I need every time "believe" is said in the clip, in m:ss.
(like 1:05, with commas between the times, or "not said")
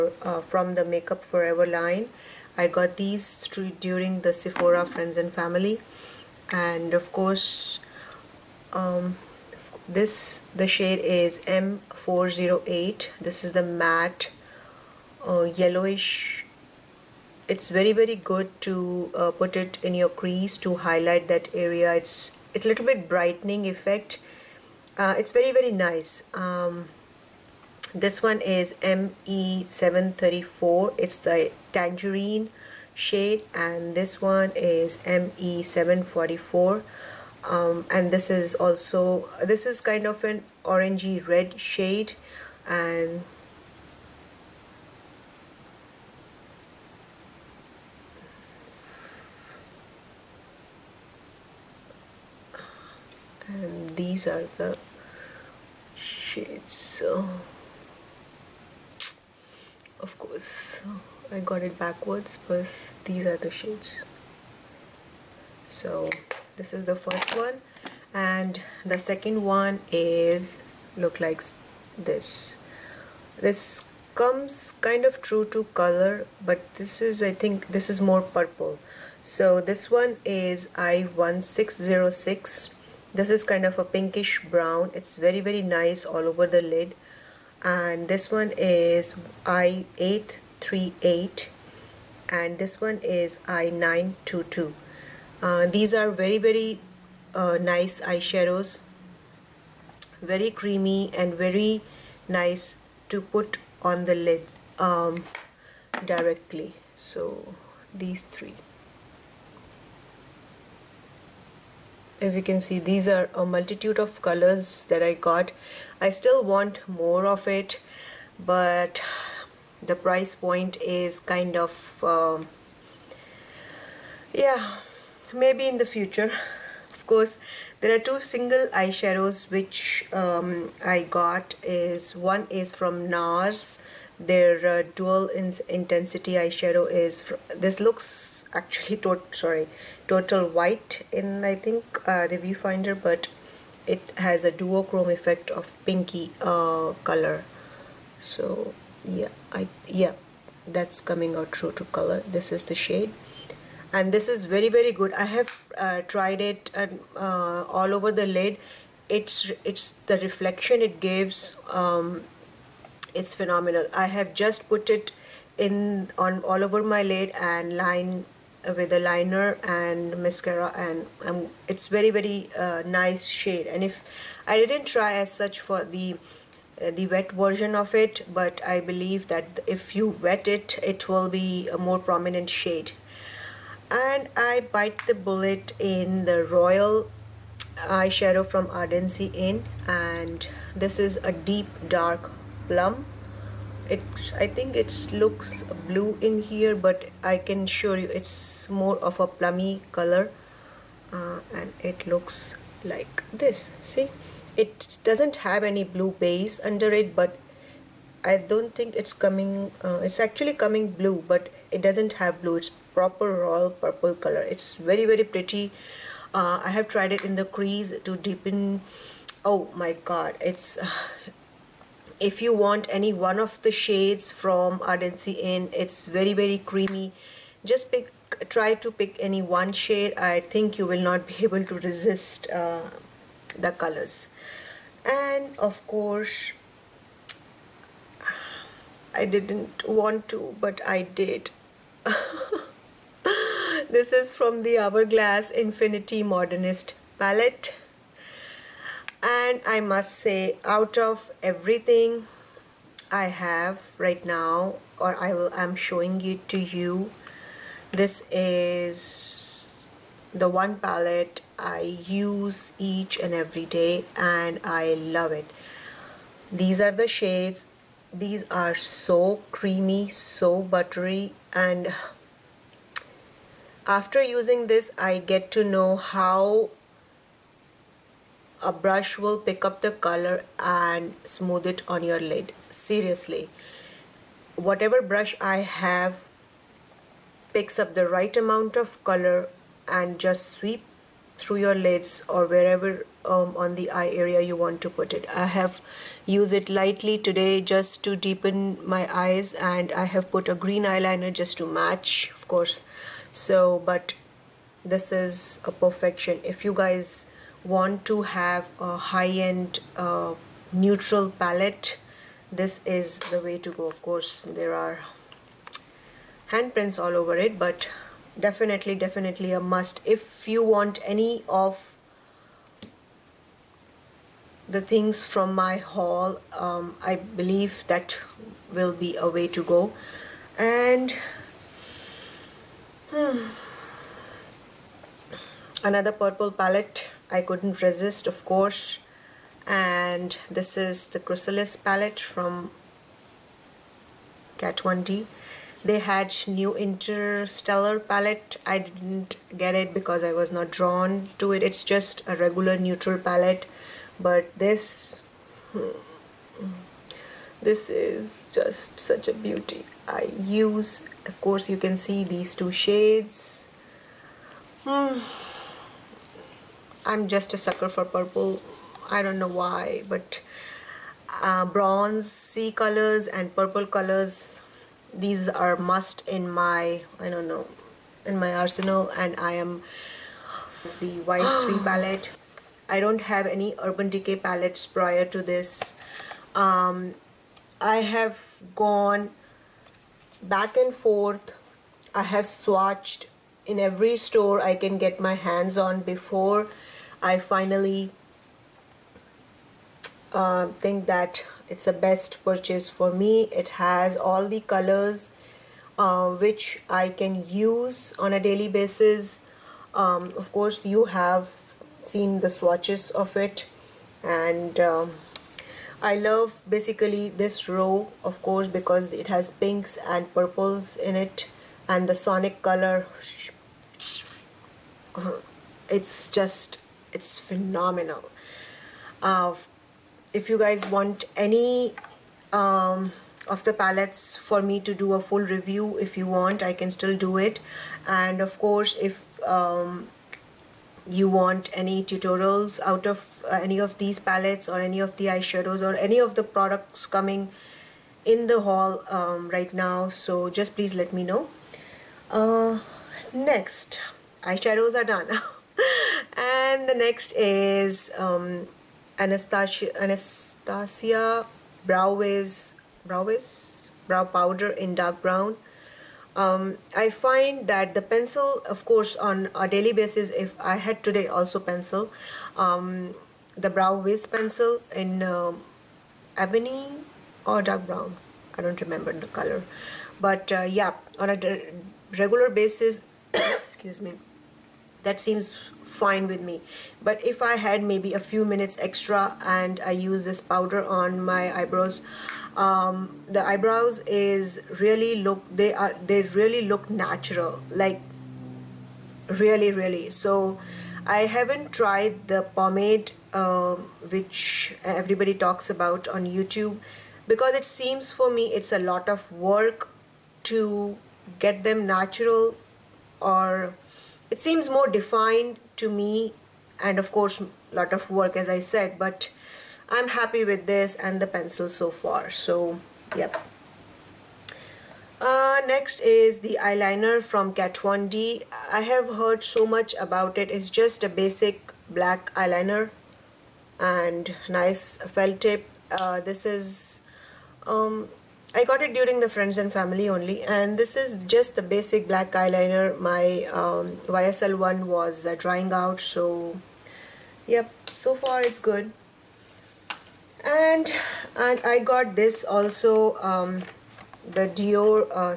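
2:58, 5:27.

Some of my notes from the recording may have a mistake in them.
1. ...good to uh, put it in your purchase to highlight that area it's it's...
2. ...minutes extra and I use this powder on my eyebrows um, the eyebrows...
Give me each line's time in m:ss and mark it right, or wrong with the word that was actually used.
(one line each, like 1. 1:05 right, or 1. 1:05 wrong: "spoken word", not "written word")
1. 0:18 wrong: "crease", not "purchase"
2. 8:08 right.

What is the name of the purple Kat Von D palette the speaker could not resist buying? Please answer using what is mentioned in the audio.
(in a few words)
Chrysalis.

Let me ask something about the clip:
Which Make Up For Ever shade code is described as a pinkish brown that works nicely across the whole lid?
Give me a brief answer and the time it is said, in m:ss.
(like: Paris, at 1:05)
I1606, at 1:20.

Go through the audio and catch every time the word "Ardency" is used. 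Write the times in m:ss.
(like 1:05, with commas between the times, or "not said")
3:08, 3:44.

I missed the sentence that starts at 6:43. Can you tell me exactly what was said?
It has all the colors uh, which I can use on a daily basis.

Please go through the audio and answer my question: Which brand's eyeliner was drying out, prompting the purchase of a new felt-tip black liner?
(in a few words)
YSL.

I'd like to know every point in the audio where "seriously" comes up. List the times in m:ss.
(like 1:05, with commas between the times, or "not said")
4:42.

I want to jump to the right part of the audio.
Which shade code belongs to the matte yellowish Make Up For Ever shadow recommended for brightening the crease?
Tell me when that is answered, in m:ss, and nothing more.
0:11.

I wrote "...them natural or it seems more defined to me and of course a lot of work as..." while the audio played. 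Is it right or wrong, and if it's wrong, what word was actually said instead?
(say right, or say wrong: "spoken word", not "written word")
right.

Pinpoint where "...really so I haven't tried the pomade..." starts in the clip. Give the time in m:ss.
8:19.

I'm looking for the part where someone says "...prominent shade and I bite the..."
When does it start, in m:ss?
3:01.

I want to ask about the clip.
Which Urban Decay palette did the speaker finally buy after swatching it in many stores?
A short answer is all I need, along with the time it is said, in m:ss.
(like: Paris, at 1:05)
Vice 3, at 6:21.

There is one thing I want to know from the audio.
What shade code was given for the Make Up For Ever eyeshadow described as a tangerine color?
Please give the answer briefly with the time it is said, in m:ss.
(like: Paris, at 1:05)
ME734, at 0:28.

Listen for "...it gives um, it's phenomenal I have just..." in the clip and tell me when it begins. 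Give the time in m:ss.
2:40.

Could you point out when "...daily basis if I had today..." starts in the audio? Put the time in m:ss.
7:49.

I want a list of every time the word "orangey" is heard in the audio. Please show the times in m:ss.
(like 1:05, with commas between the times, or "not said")
0:40.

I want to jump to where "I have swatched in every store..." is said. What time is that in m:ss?
6:32.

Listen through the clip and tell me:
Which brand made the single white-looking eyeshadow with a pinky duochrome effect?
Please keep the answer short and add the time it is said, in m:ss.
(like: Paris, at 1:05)
NARS, at 2:13.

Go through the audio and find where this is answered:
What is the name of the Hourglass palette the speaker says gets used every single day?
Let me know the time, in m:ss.
4:05.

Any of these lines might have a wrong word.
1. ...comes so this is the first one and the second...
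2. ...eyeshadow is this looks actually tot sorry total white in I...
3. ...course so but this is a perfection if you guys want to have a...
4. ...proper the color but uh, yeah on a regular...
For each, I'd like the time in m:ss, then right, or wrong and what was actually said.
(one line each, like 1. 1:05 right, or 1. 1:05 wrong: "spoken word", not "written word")
1. 1:03 wrong: "shades", not "comes"
2. 2:16 right
3. 5:02 right
4. 7:58 wrong: "remember", not "proper".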